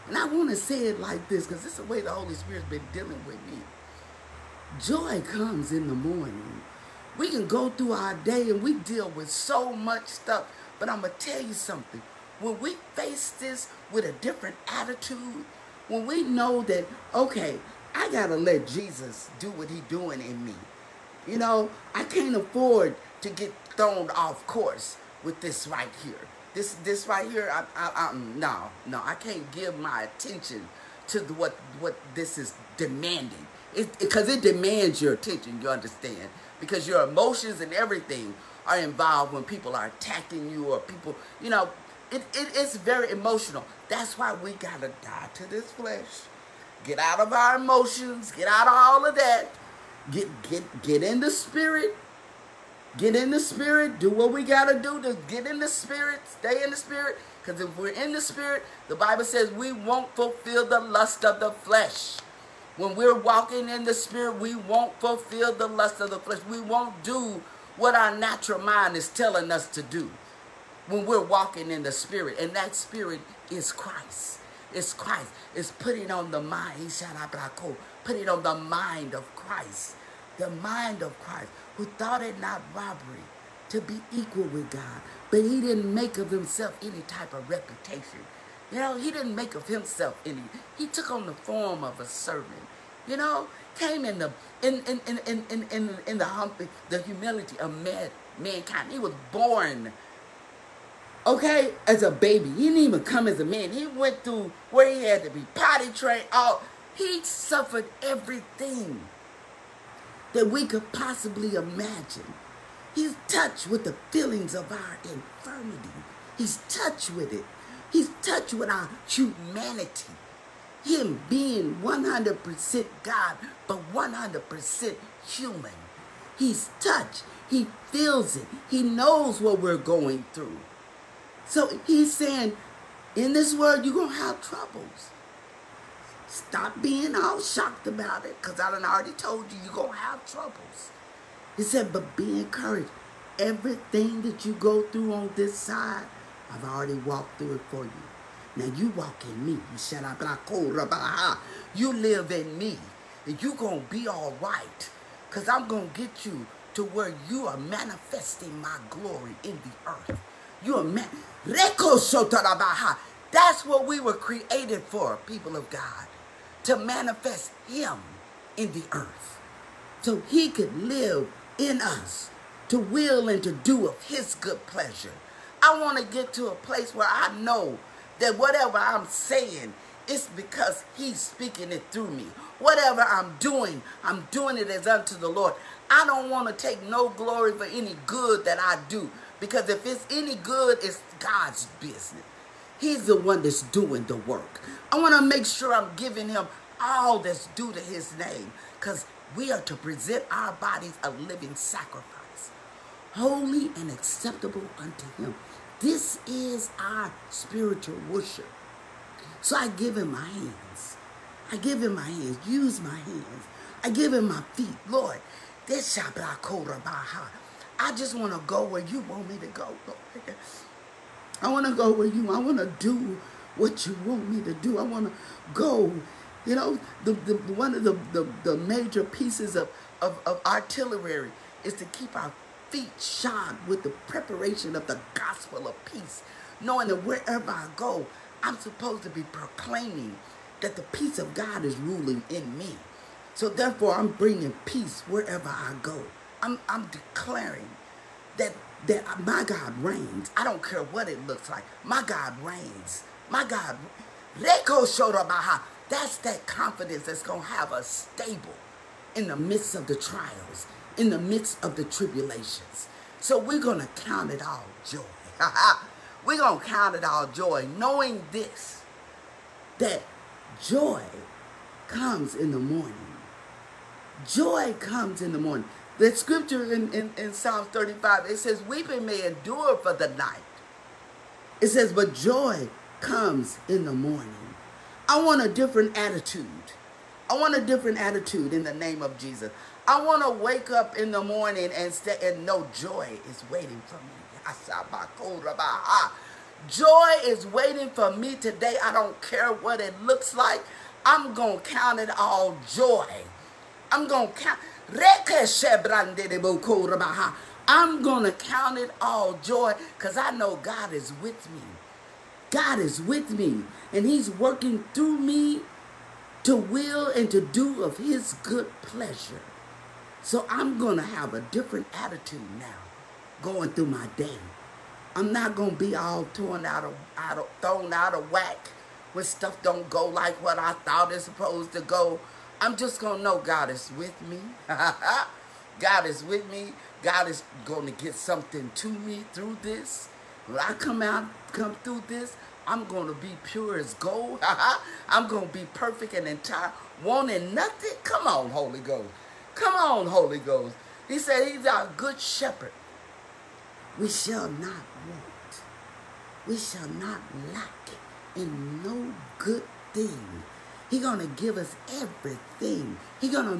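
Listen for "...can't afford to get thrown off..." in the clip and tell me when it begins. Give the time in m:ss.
0:22.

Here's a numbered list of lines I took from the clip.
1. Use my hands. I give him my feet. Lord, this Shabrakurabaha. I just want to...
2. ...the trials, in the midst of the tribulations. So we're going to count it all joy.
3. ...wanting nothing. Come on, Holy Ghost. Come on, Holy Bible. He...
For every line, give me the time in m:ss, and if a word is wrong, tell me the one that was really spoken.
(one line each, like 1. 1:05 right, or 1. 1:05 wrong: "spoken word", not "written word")
1. 3:32 right
2. 4:19 right
3. 5:47 wrong: "Ghost", not "Bible".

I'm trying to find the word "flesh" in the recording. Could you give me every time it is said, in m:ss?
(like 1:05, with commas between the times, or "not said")
0:45, 1:01, 1:06.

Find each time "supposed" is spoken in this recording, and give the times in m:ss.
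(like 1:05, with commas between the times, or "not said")
3:58, 5:31.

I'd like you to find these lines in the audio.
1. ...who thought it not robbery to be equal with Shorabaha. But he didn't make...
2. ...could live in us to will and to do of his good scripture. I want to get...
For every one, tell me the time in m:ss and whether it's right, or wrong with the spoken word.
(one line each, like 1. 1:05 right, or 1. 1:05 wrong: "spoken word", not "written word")
1. 1:21 wrong: "God", not "Shorabaha"
2. 2:50 wrong: "pleasure", not "scripture".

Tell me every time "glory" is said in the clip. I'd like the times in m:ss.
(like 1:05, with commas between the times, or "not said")
2:38, 3:07.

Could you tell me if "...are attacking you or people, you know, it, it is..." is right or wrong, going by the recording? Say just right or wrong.
right.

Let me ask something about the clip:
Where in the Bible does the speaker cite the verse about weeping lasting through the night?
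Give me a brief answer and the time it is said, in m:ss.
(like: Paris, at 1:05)
Psalm 35, at 4:37.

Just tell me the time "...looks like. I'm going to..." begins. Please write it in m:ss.
5:00.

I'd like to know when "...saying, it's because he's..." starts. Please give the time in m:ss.
2:59.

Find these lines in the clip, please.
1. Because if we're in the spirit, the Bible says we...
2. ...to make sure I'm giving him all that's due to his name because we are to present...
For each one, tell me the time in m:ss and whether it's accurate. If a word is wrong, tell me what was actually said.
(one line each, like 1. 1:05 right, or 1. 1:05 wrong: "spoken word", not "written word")
1. 0:57 right
2. 3:15 right.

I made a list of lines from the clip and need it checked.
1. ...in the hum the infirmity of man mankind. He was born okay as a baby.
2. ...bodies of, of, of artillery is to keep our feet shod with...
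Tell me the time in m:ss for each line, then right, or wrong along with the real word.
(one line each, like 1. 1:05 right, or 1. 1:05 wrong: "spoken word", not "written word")
1. 1:36 wrong: "humility", not "infirmity"
2. 3:49 wrong: "pieces", not "bodies".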